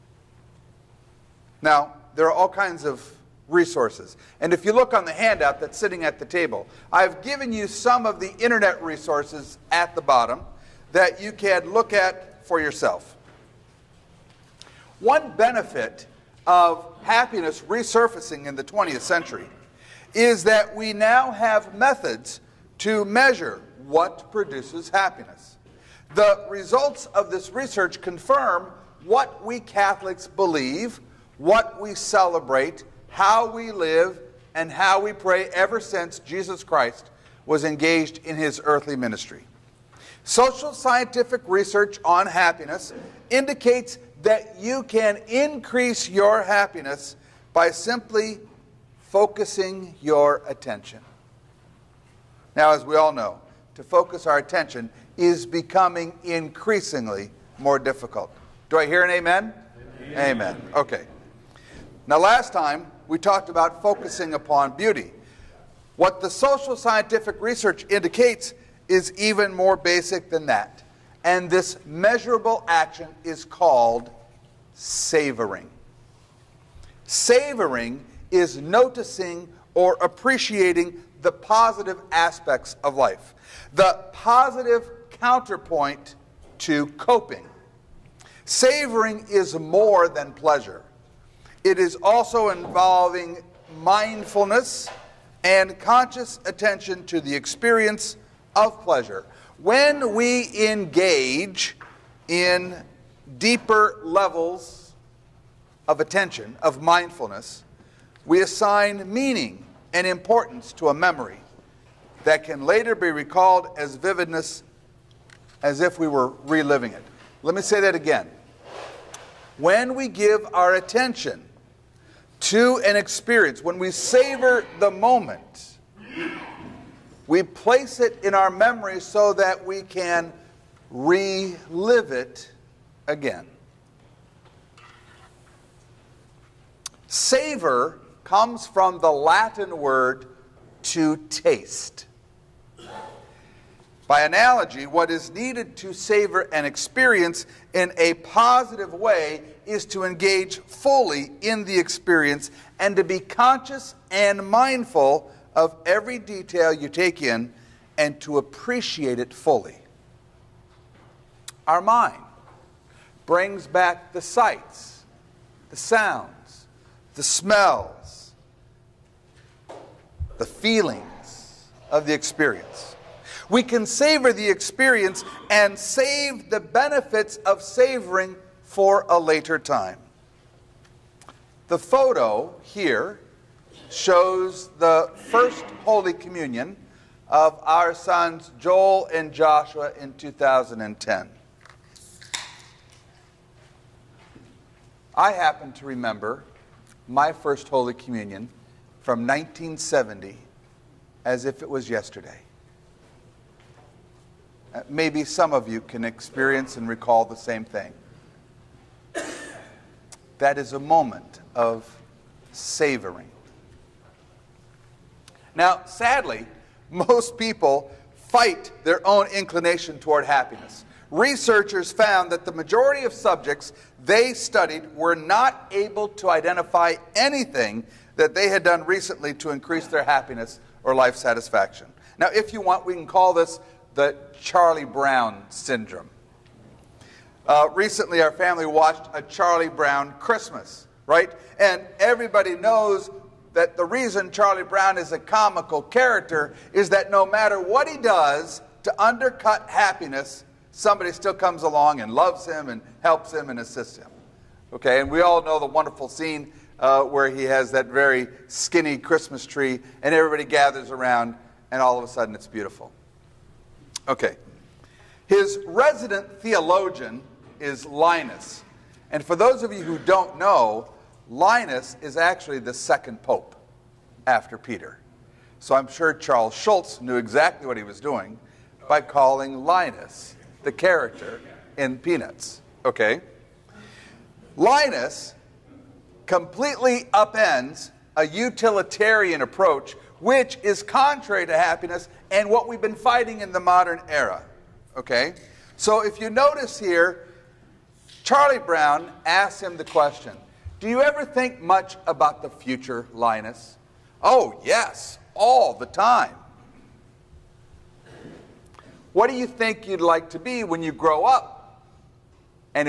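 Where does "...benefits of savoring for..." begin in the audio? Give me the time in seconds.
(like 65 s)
176 s.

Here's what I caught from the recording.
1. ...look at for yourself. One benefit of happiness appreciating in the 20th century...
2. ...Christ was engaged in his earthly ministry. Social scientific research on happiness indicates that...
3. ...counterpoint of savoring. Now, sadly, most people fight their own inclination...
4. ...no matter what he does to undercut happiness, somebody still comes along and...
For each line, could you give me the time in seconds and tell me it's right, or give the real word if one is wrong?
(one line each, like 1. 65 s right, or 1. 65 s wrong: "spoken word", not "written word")
1. 11 s wrong: "resurfacing", not "appreciating"
2. 36 s right
3. 210 s wrong: "moment", not "counterpoint"
4. 247 s right.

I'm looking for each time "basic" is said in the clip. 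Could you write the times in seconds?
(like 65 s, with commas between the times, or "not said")
69 s.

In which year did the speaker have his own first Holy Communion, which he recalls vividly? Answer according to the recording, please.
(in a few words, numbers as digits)
1970.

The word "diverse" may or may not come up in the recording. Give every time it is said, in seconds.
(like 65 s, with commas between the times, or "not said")
not said.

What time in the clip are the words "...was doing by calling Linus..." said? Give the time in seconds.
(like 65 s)
277 s.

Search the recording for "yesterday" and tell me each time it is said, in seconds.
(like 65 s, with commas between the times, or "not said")
201 s.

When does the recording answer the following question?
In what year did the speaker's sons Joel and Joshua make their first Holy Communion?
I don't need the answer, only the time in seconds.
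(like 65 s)
190 s.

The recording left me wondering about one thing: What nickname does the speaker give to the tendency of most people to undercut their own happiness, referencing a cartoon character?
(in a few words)
Charlie Brown syndrome.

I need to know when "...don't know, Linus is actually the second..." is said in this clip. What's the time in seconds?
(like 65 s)
269 s.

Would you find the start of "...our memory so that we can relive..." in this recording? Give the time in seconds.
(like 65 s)
128 s.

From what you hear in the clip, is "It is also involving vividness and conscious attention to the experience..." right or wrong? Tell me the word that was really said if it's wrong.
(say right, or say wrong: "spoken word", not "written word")
wrong: "mindfulness", not "vividness".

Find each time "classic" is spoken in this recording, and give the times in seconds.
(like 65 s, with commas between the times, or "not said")
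not said.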